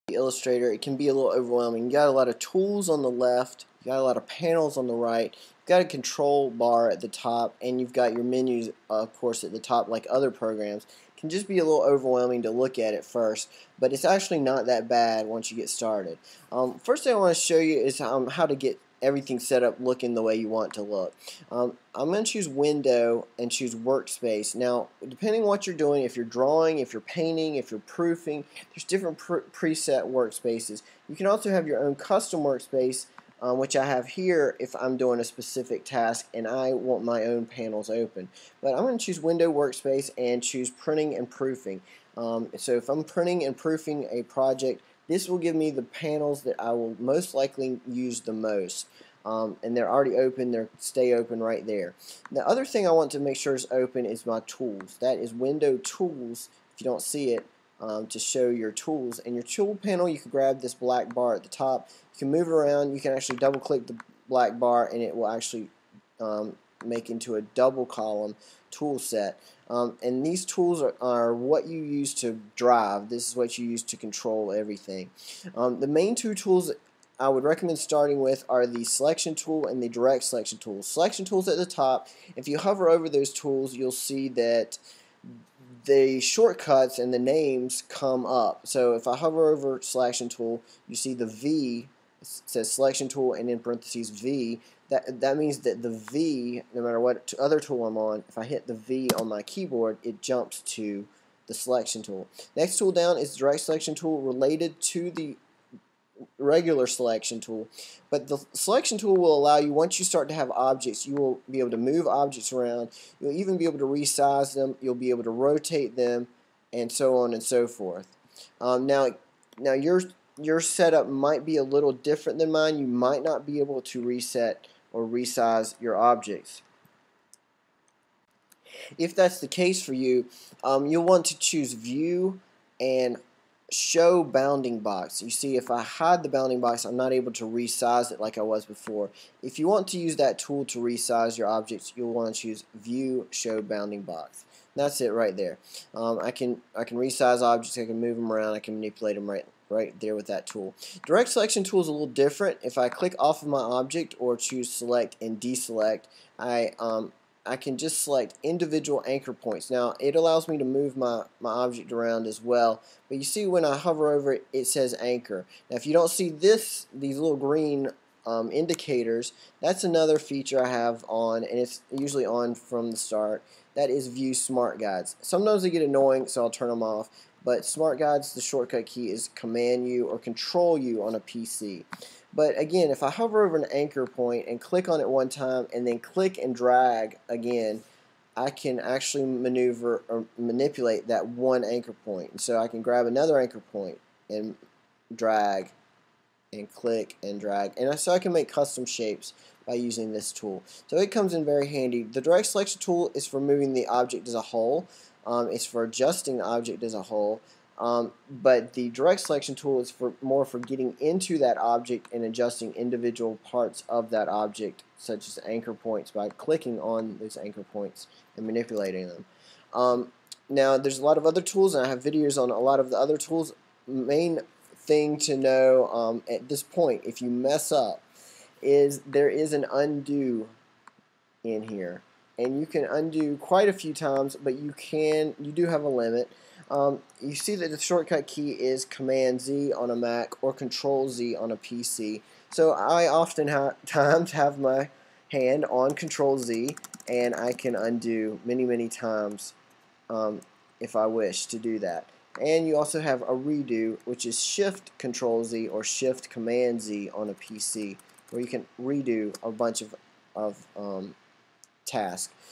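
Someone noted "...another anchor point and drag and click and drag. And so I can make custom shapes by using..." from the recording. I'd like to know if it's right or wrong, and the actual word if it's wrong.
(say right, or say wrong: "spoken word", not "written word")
right.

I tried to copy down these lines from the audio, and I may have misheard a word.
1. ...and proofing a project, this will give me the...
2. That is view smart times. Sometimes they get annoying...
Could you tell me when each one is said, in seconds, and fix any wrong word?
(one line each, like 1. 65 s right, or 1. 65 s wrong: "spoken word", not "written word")
1. 43 s right
2. 173 s wrong: "guides", not "times".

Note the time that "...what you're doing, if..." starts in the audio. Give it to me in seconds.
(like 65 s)
25 s.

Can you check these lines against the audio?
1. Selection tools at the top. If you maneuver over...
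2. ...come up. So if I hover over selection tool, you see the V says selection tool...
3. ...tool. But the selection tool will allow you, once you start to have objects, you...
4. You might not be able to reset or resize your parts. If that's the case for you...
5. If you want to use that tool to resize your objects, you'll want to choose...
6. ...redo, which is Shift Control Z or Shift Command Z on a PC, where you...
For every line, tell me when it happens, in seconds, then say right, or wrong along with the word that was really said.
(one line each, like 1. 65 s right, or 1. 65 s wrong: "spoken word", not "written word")
1. 80 s wrong: "hover", not "maneuver"
2. 87 s right
3. 107 s right
4. 122 s wrong: "objects", not "parts"
5. 139 s right
6. 253 s right.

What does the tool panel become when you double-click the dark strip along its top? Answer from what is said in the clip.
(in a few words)
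double column tool set.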